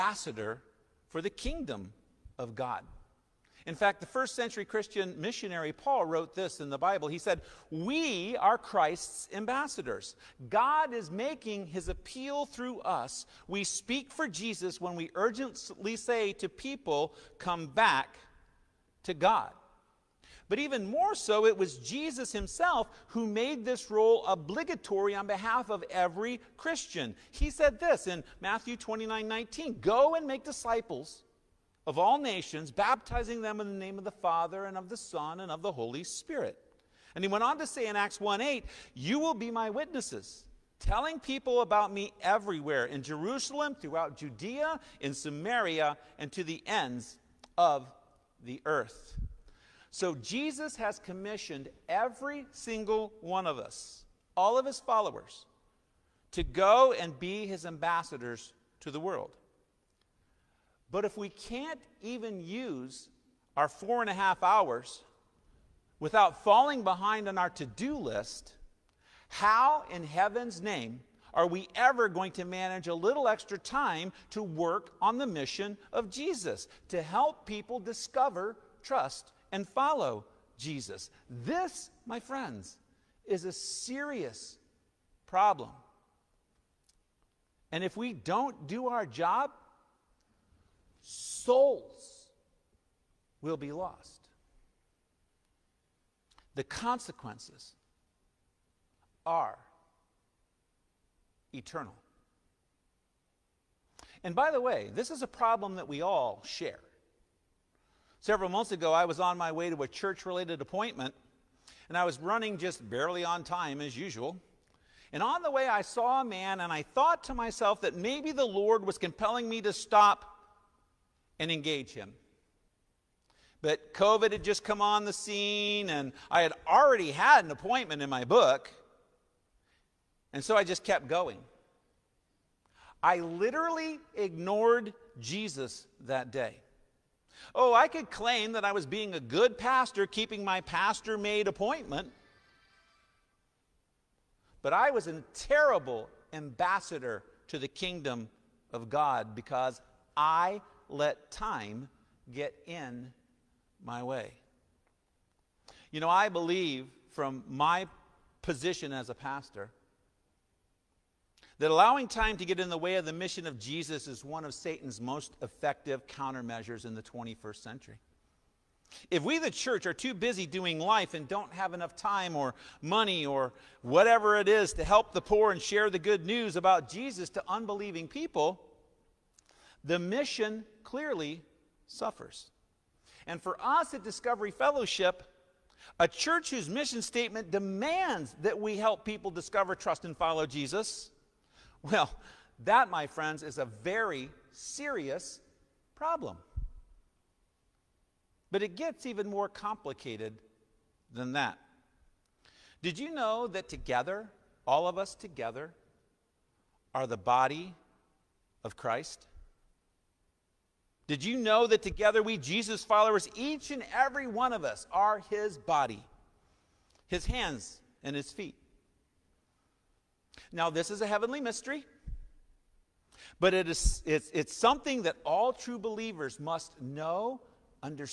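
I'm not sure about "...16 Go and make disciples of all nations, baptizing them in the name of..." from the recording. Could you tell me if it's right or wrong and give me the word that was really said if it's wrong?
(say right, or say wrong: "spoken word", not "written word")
wrong: "19", not "16".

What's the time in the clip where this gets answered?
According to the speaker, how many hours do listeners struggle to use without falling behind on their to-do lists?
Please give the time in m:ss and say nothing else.
1:03.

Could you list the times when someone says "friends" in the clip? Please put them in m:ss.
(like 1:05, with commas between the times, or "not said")
1:22, 3:13.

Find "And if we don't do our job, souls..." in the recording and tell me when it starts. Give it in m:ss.
1:27.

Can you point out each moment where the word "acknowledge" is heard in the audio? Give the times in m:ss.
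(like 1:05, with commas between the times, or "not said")
not said.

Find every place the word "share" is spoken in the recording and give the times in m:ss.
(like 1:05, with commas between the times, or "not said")
1:46, 2:55.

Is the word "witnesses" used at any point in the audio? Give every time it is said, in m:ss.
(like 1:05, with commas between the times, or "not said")
0:39.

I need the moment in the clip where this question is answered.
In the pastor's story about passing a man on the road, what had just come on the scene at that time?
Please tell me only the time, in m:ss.
2:03.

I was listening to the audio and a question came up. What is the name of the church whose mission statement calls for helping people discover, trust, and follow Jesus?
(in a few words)
Discovery Fellowship.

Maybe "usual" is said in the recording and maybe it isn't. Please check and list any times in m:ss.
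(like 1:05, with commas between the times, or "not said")
1:53.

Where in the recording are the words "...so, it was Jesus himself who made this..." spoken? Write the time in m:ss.
0:21.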